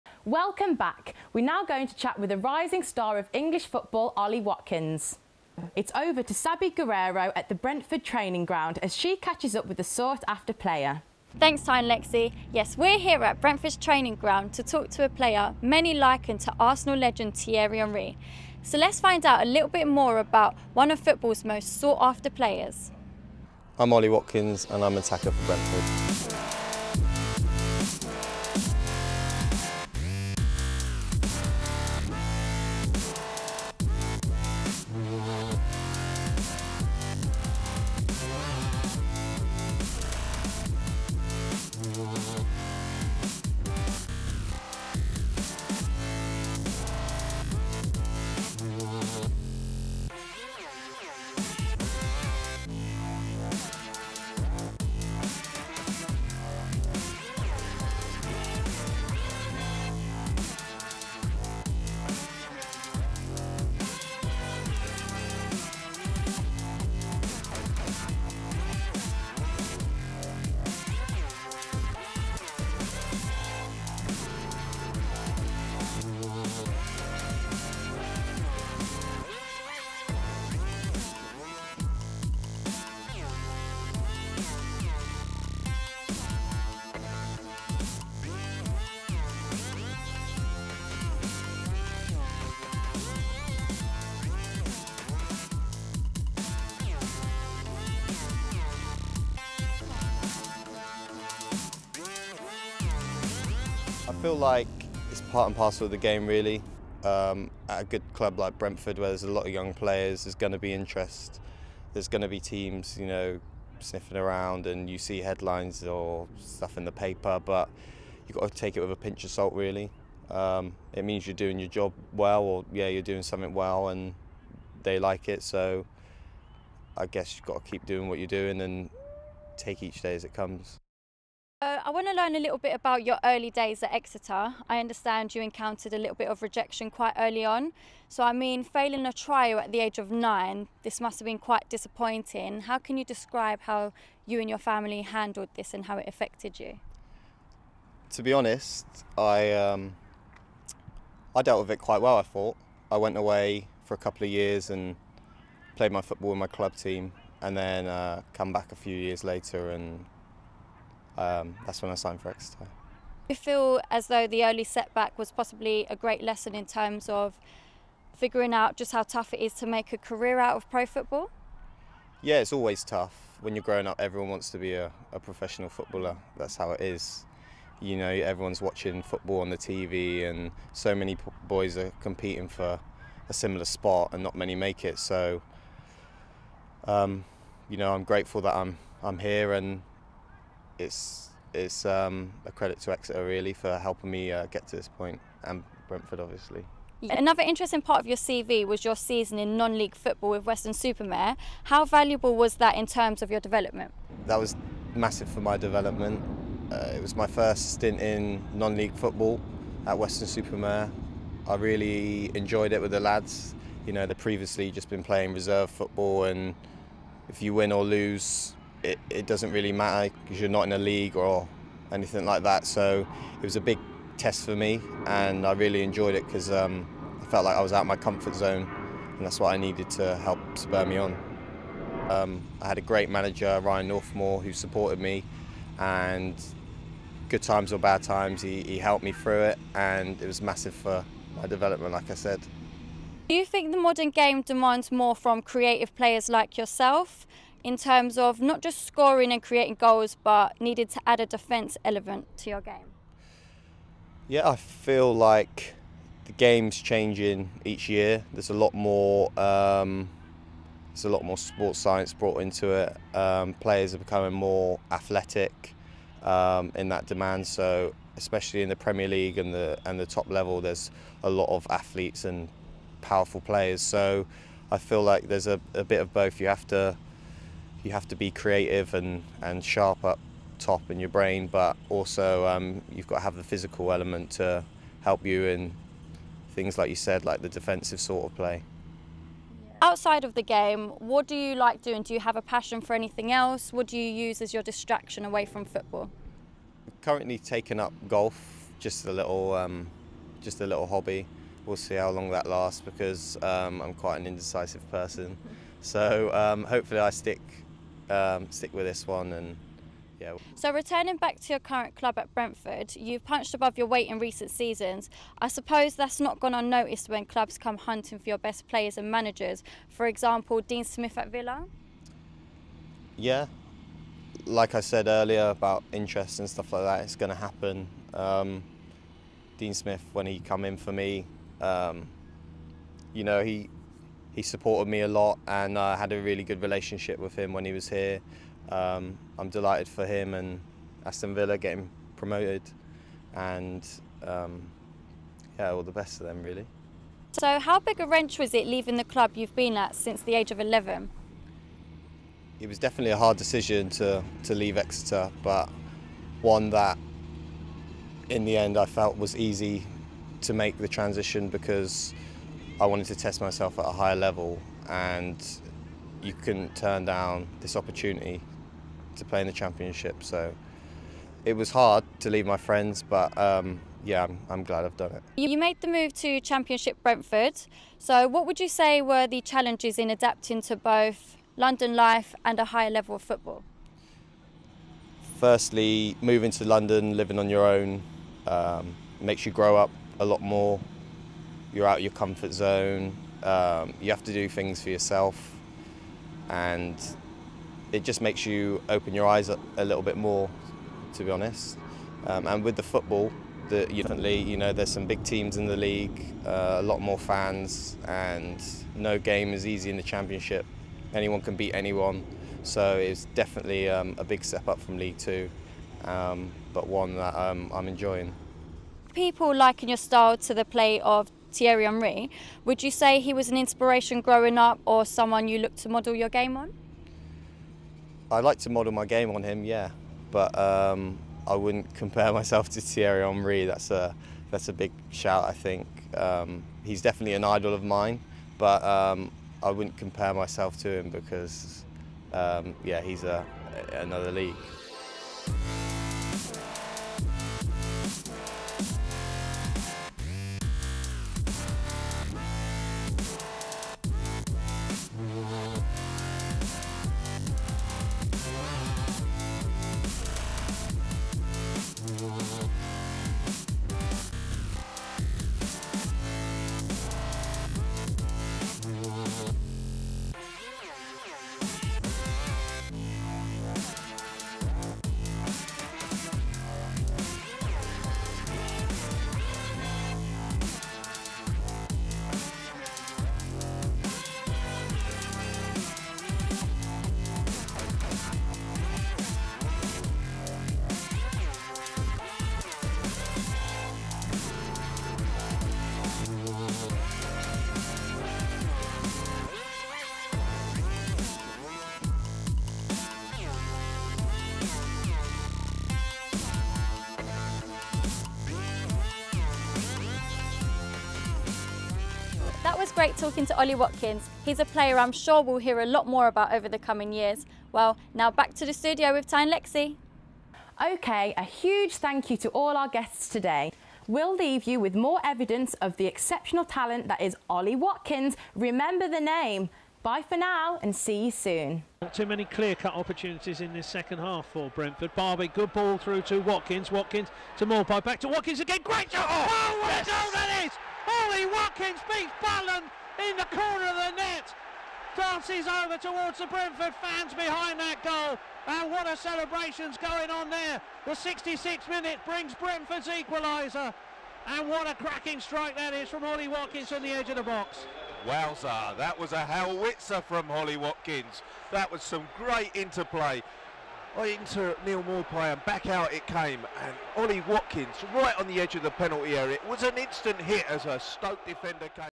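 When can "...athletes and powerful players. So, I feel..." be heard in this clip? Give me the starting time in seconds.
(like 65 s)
271 s.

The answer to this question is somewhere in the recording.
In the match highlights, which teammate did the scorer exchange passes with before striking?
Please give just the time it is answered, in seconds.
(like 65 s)
564 s.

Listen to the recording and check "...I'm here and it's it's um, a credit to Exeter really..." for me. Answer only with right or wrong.
right.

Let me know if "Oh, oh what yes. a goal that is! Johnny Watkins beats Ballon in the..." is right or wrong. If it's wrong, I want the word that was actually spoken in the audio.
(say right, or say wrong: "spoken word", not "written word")
right.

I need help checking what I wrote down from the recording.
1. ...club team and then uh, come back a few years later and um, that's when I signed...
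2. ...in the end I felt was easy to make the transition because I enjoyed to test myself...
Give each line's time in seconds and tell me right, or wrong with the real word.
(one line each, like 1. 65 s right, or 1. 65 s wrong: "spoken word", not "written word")
1. 156 s right
2. 358 s wrong: "wanted", not "enjoyed".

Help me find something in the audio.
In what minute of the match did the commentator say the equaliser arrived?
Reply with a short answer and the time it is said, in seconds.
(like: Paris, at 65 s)
66, at 551 s.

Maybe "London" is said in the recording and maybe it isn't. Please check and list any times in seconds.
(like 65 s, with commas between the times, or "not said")
381 s, 386 s.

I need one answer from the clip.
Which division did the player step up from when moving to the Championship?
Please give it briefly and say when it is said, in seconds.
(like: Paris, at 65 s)
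League Two, at 414 s.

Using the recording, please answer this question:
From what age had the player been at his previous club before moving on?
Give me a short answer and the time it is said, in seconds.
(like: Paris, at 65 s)
11, at 350 s.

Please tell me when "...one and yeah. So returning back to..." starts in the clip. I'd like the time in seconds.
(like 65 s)
309 s.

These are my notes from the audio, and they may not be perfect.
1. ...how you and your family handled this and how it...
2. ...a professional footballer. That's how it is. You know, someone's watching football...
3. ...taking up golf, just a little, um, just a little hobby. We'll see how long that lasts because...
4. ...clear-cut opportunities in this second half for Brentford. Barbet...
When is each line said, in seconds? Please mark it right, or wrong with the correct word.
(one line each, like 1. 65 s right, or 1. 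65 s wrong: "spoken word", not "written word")
1. 143 s right
2. 175 s wrong: "everyone", not "someone"
3. 297 s right
4. 532 s right.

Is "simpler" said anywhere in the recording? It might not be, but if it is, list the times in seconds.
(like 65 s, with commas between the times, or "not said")
not said.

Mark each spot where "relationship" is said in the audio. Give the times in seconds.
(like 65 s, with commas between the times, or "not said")
336 s.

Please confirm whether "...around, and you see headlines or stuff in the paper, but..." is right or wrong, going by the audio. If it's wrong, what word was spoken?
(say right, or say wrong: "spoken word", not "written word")
right.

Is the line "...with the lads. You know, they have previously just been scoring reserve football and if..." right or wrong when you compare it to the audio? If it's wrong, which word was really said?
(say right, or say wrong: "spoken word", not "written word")
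wrong: "playing", not "scoring".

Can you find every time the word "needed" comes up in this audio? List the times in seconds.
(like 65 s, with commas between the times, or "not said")
229 s, 250 s.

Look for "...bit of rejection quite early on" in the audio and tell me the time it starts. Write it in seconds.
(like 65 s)
136 s.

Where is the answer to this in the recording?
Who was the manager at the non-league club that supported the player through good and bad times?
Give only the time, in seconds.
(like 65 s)
233 s.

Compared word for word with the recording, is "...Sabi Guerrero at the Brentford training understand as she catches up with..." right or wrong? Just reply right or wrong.
wrong.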